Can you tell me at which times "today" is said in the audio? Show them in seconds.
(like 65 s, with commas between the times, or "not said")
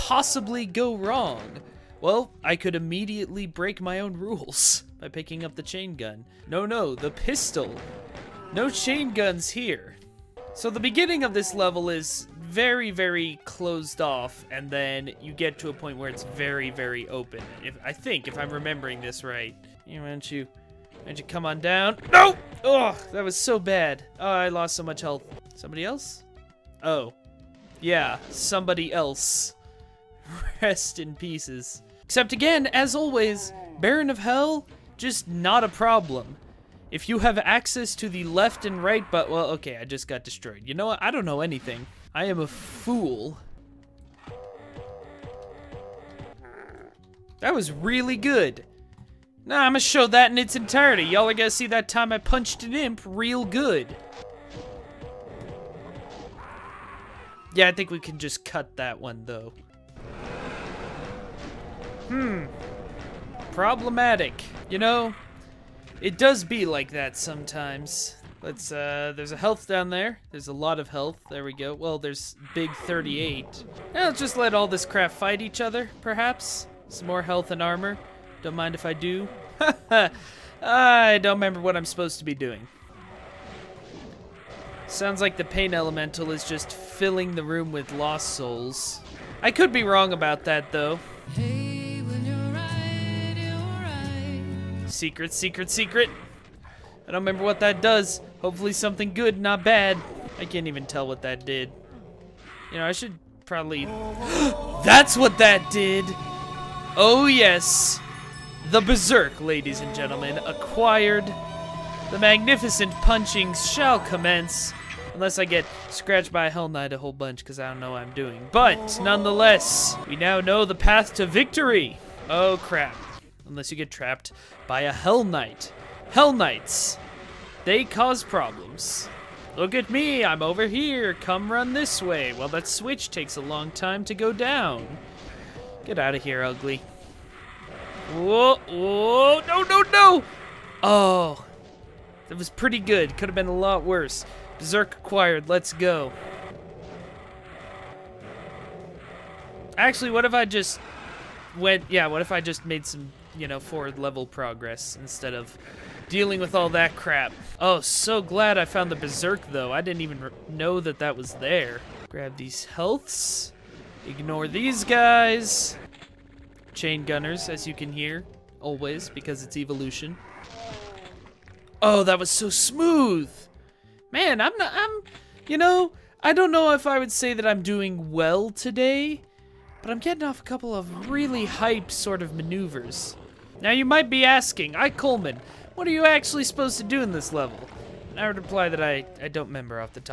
178 s.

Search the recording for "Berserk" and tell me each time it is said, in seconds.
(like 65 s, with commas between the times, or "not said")
108 s, 144 s, 158 s.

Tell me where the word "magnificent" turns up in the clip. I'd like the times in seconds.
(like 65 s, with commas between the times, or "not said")
112 s.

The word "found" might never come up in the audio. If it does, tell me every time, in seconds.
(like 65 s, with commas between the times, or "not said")
158 s.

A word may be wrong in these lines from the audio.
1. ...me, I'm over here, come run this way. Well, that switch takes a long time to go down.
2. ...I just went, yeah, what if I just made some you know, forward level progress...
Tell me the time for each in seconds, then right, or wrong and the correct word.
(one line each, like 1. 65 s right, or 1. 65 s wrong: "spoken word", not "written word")
1. 129 s right
2. 150 s right.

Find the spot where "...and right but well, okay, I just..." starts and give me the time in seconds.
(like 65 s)
38 s.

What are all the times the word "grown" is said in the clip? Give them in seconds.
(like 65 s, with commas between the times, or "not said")
not said.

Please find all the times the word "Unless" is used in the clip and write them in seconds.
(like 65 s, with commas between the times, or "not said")
115 s, 123 s.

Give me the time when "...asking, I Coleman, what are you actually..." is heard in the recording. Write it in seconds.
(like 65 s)
184 s.